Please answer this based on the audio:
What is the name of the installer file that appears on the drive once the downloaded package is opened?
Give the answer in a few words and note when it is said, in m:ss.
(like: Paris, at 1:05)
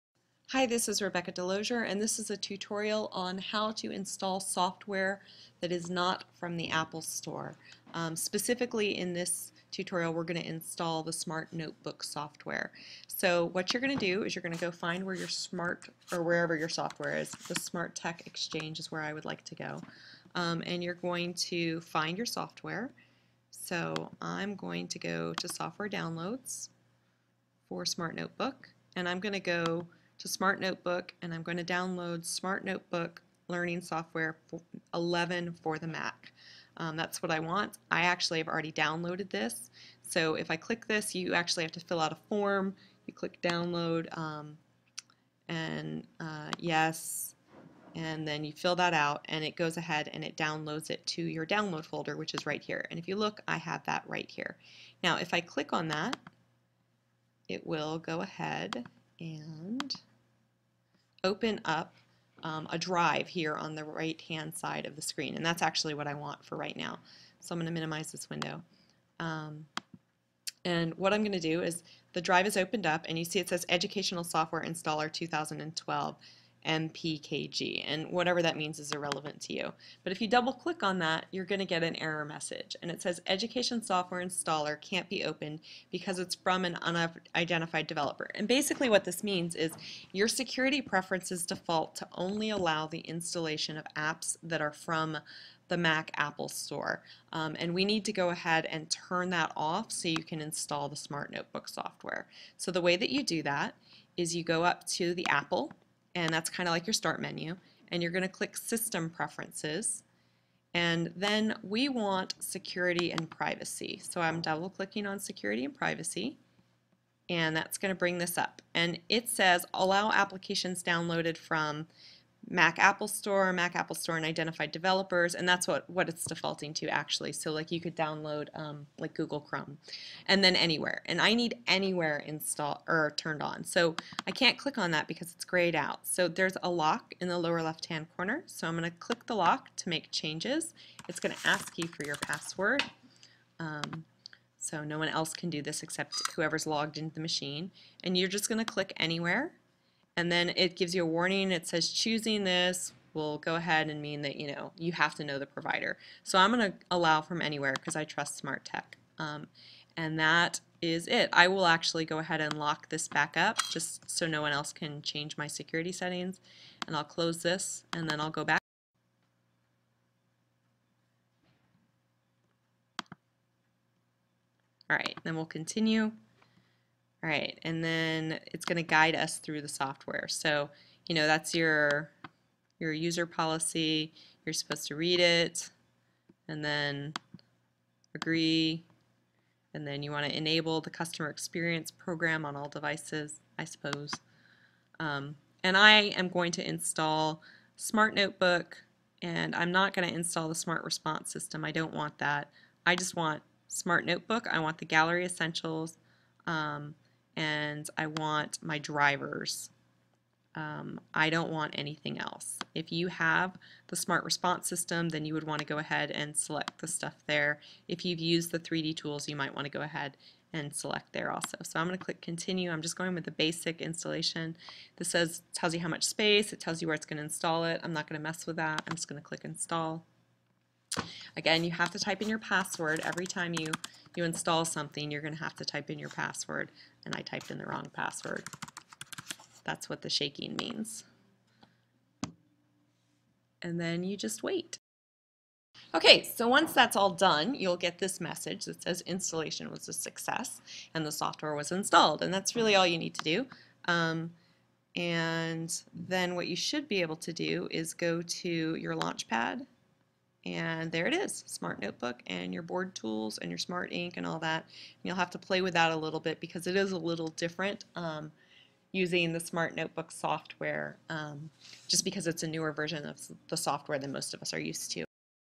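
Educational Software Installer 2012, at 1:13.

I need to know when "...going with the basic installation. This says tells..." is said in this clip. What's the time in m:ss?
3:42.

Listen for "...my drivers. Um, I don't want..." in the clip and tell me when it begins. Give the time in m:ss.
3:28.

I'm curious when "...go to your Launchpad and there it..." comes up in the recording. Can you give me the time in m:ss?
4:17.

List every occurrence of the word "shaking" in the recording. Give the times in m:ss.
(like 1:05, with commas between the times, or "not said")
4:00.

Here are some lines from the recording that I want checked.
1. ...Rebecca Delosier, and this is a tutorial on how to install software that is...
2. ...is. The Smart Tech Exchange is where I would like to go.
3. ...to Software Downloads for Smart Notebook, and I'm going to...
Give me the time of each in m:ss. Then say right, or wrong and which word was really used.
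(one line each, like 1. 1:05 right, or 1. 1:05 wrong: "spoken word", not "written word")
1. 0:01 right
2. 0:17 right
3. 0:25 right.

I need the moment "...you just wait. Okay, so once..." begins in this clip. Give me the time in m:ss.
4:04.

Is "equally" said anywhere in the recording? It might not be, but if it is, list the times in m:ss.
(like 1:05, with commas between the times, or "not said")
not said.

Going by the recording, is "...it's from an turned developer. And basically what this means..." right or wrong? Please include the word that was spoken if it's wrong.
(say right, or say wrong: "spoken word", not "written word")
wrong: "unidentified", not "turned".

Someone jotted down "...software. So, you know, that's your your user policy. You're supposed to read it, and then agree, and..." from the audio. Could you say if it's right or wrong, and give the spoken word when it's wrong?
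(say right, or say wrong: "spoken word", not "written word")
right.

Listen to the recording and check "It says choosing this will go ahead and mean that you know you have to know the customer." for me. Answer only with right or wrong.
wrong.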